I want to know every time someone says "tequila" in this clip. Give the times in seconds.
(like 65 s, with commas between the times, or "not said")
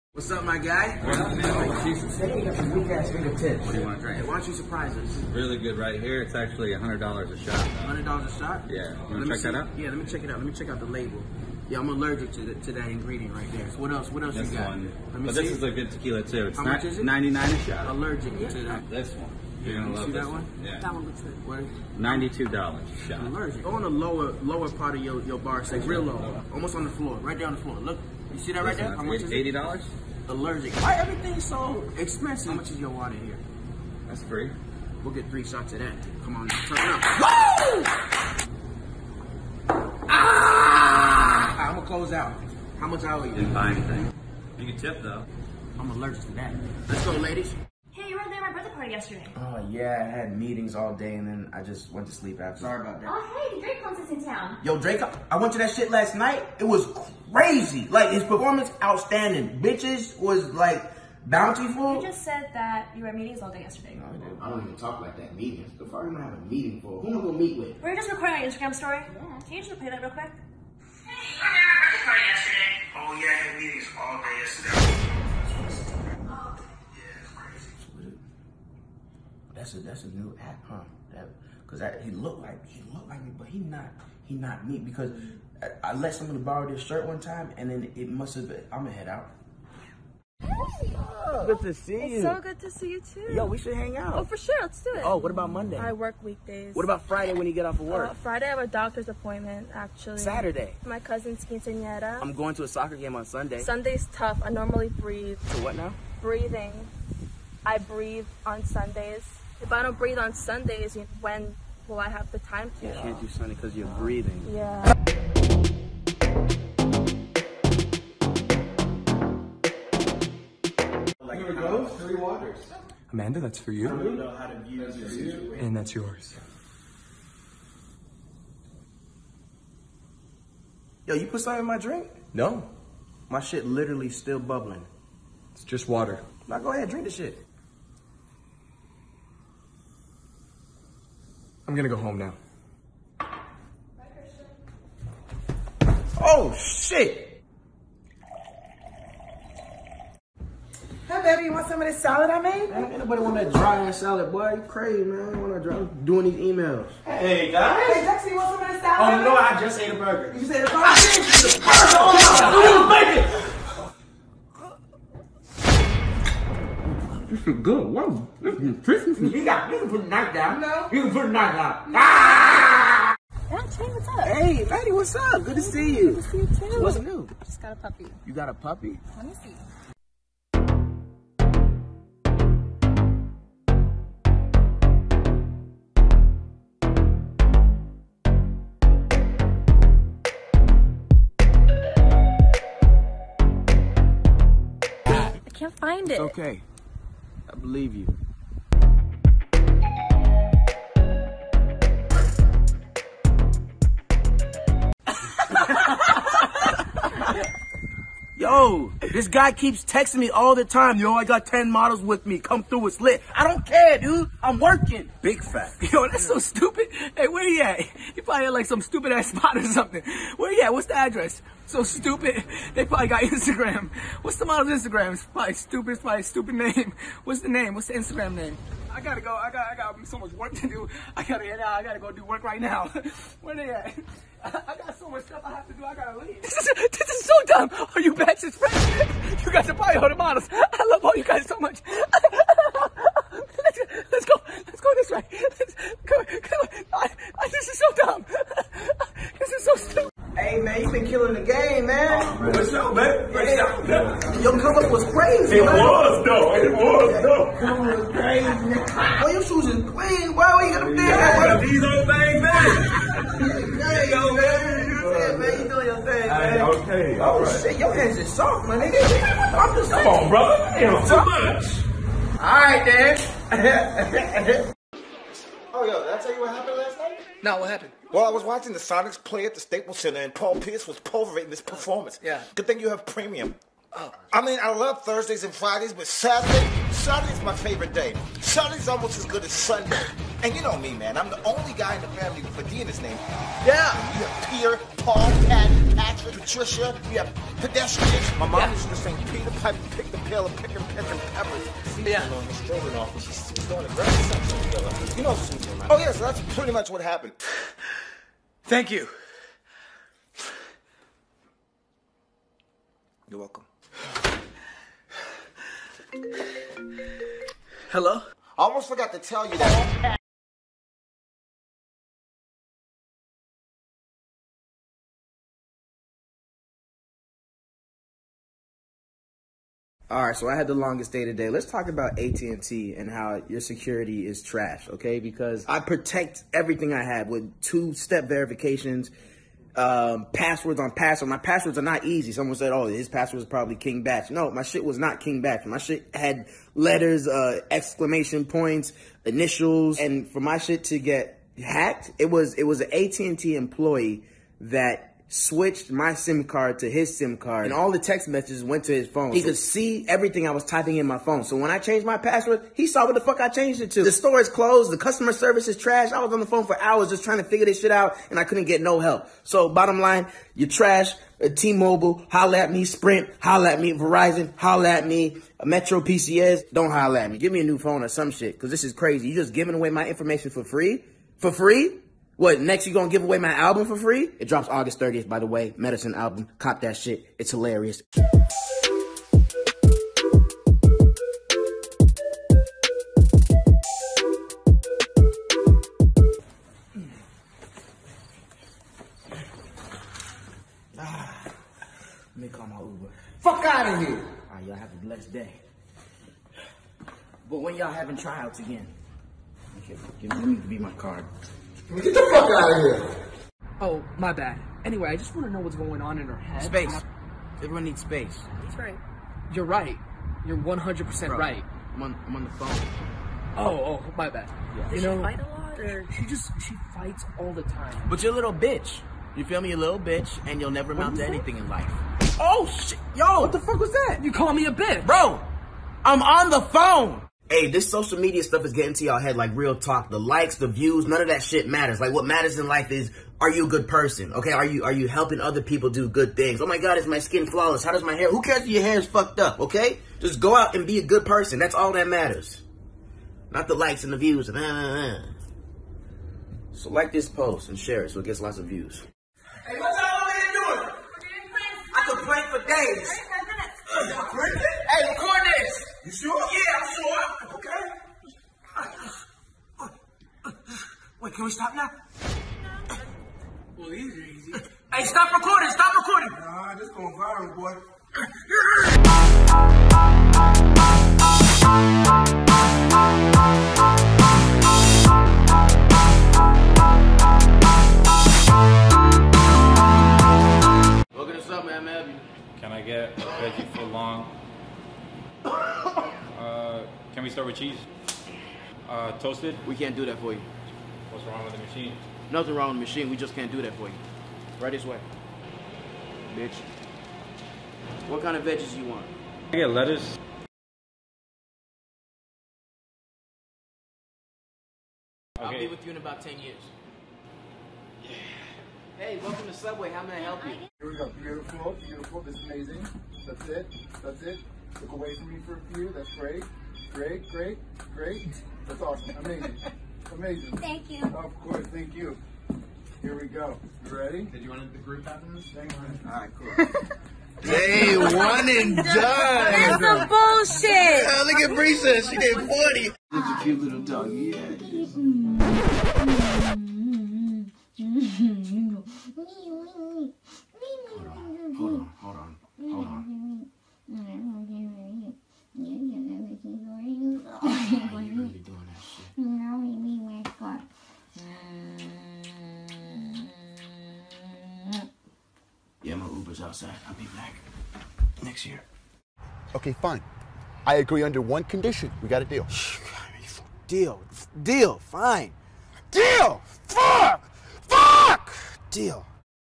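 15 s.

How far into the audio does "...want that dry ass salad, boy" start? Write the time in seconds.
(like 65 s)
153 s.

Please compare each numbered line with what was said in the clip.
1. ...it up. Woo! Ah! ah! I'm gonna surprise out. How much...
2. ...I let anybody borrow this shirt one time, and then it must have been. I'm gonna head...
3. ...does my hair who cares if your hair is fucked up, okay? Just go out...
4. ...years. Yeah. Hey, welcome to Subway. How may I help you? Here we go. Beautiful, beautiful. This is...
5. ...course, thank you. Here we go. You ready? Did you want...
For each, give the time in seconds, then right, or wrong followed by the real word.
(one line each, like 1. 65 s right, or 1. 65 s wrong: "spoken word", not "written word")
1. 37 s wrong: "close", not "surprise"
2. 85 s wrong: "somebody", not "anybody"
3. 447 s right
4. 516 s right
5. 531 s right.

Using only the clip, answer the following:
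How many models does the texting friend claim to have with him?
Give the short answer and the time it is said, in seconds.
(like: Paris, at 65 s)
10, at 211 s.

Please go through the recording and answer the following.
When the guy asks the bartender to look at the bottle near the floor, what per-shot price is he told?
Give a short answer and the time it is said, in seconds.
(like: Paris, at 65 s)
$80, at 29 s.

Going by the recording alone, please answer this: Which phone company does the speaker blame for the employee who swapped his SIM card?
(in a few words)
AT&T.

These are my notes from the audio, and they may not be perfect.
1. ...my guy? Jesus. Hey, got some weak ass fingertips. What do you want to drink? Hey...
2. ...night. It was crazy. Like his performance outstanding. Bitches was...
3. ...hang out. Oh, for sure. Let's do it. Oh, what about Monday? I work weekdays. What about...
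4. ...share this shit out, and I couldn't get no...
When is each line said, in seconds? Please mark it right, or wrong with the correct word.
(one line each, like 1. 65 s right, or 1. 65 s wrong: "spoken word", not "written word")
1. 0 s right
2. 56 s right
3. 93 s right
4. 367 s wrong: "figure", not "share".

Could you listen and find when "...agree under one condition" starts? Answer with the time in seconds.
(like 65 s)
570 s.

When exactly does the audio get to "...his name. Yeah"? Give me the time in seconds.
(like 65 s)
292 s.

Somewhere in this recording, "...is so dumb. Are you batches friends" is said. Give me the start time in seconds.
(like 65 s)
237 s.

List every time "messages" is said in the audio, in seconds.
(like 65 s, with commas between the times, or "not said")
358 s.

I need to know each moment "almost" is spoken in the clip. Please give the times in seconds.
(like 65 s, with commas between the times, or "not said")
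26 s, 288 s, 318 s.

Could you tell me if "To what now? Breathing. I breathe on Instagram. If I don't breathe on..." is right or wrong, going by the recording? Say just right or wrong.
wrong.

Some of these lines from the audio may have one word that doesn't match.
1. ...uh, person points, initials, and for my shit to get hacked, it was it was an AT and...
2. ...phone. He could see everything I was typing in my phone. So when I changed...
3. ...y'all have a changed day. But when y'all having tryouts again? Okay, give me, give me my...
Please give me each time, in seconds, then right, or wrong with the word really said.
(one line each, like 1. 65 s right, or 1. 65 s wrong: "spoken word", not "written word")
1. 347 s wrong: "exclamation", not "person"
2. 359 s right
3. 404 s wrong: "blessed", not "changed".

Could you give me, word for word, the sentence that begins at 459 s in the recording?
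Hey, what y'all over here doing?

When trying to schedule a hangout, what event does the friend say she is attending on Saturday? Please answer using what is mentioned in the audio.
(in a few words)
Cousin's quinceañera.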